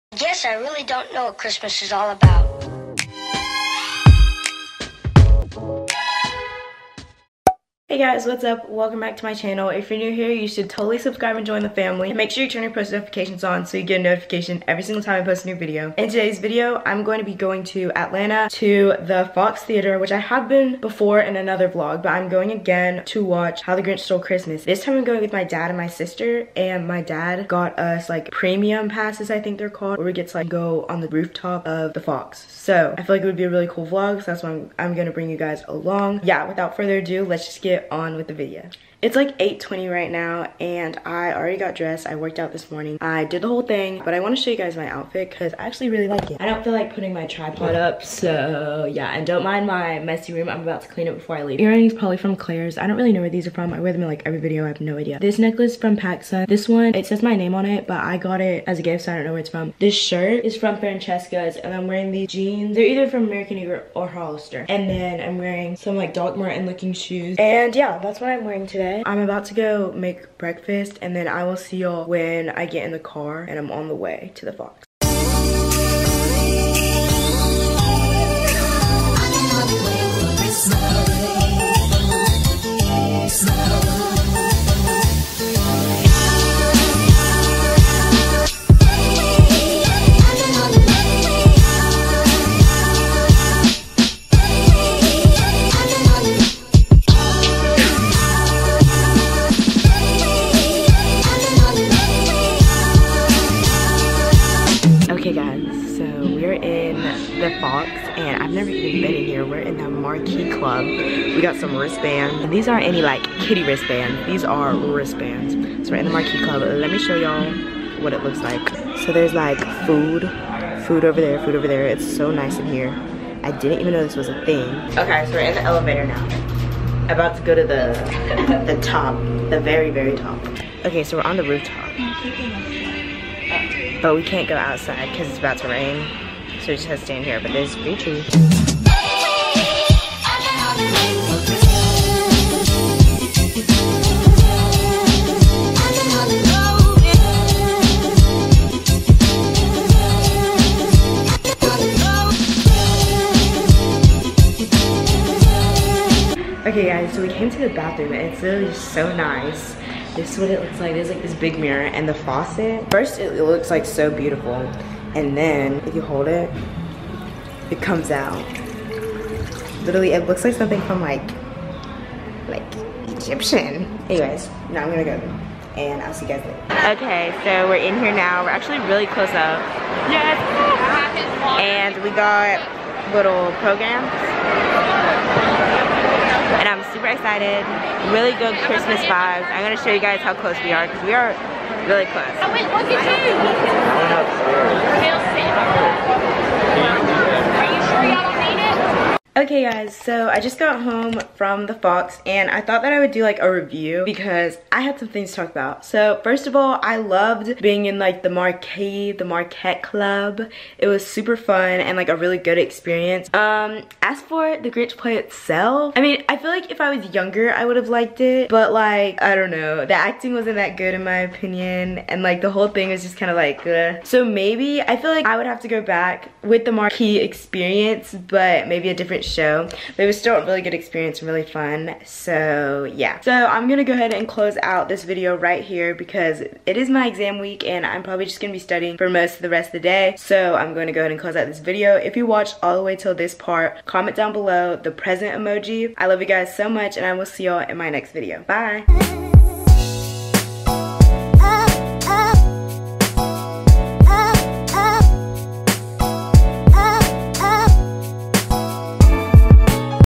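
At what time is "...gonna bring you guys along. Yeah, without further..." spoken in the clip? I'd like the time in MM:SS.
00:34.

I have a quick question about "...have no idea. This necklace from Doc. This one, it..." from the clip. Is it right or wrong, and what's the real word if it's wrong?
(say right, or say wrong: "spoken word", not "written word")
wrong: "PacSun", not "Doc".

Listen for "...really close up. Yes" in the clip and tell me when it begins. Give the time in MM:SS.
02:58.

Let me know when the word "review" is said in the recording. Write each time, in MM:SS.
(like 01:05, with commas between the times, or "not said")
03:23.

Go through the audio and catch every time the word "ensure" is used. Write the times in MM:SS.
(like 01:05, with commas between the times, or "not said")
not said.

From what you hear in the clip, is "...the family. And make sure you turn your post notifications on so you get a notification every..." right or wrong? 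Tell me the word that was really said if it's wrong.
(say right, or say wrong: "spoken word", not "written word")
right.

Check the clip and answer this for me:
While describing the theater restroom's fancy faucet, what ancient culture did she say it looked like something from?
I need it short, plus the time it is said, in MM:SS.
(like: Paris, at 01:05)
Egyptian, at 02:53.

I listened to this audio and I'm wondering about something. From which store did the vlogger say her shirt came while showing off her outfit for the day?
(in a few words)
Francesca's.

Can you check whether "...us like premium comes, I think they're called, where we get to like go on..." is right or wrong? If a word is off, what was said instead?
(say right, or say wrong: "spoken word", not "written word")
wrong: "passes", not "comes".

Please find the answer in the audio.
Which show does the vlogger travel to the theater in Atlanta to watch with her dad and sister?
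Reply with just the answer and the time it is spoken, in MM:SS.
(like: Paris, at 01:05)
How the Grinch Stole Christmas, at 00:23.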